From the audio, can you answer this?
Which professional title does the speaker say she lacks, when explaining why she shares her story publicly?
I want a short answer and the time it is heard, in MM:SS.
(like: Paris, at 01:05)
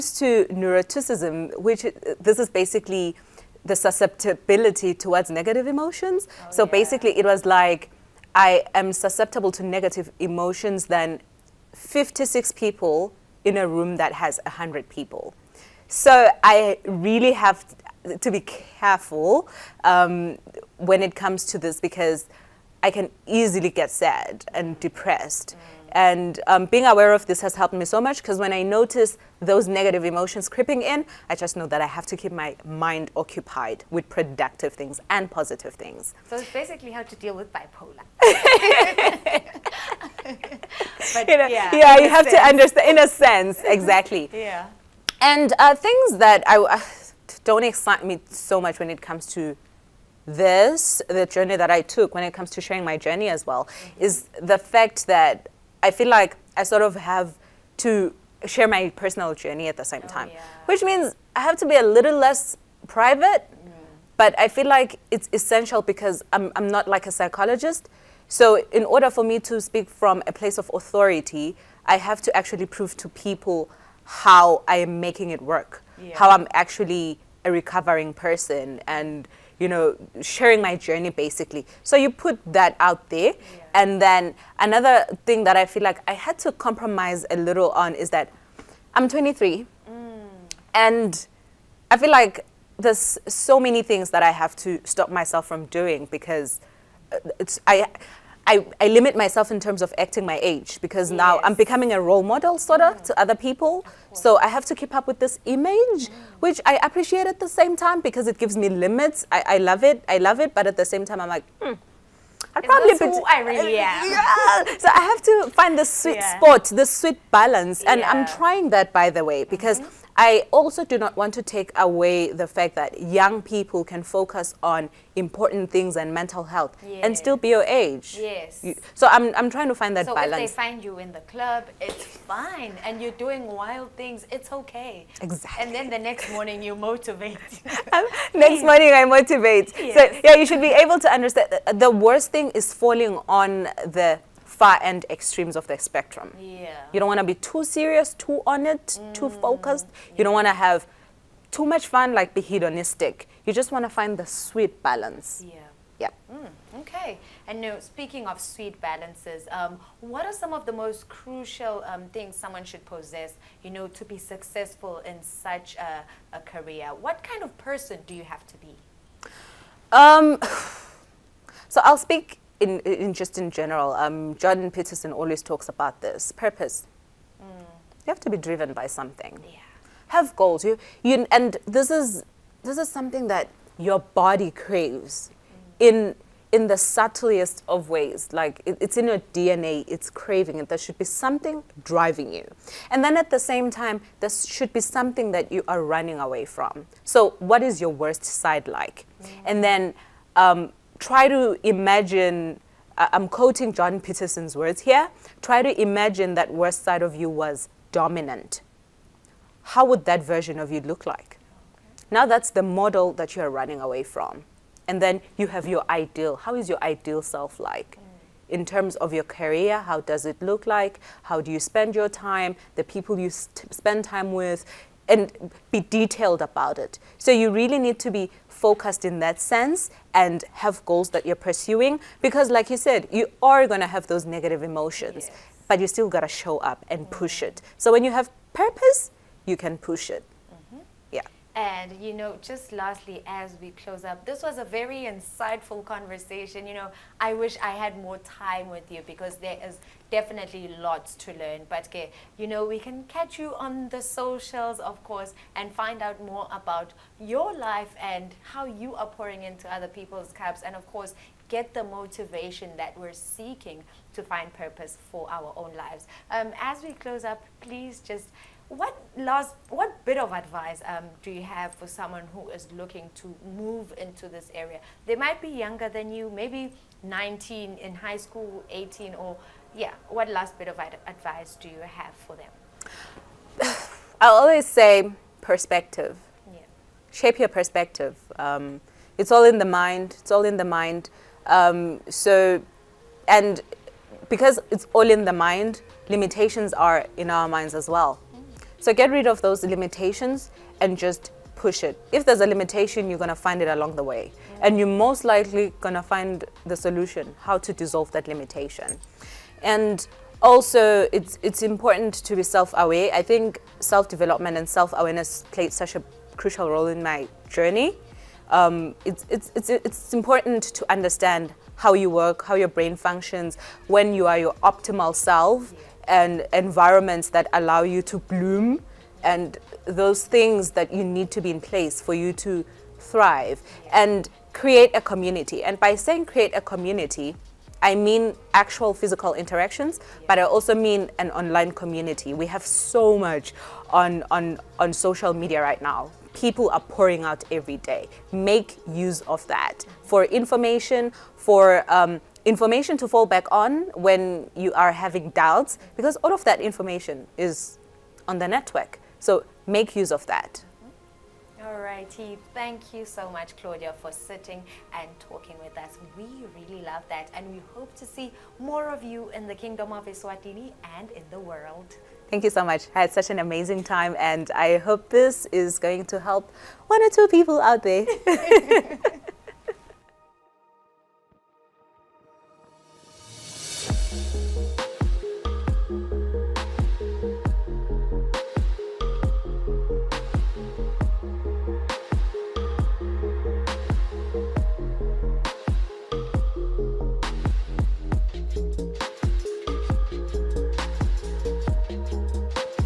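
psychologist, at 01:07.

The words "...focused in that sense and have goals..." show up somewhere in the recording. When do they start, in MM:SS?
03:48.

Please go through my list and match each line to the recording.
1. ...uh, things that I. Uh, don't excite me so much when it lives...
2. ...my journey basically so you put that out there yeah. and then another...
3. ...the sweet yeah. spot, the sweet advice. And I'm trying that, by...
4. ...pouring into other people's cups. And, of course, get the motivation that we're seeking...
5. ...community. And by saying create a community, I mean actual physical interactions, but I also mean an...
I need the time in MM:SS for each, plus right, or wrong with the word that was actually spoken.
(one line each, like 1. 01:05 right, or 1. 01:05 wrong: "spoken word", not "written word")
1. 00:45 wrong: "comes", not "lives"
2. 01:20 right
3. 01:55 wrong: "balance", not "advice"
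4. 04:19 right
5. 05:35 right.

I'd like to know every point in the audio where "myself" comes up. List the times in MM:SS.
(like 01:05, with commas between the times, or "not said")
01:35, 01:39.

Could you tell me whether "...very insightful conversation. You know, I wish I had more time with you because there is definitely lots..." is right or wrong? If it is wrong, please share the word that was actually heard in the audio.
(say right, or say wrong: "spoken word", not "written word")
right.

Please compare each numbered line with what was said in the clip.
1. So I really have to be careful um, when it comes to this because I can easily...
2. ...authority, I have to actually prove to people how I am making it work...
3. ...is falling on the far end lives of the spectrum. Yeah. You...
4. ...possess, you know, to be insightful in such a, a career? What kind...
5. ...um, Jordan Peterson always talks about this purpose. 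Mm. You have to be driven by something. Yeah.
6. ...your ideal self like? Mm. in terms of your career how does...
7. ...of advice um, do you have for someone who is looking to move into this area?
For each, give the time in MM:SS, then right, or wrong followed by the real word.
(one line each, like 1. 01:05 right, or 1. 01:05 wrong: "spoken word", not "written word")
1. 00:15 right
2. 01:10 right
3. 02:22 wrong: "extremes", not "lives"
4. 02:42 wrong: "successful", not "insightful"
5. 02:53 right
6. 03:36 right
7. 04:30 right.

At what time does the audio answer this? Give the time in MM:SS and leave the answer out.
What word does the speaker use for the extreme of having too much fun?
02:32.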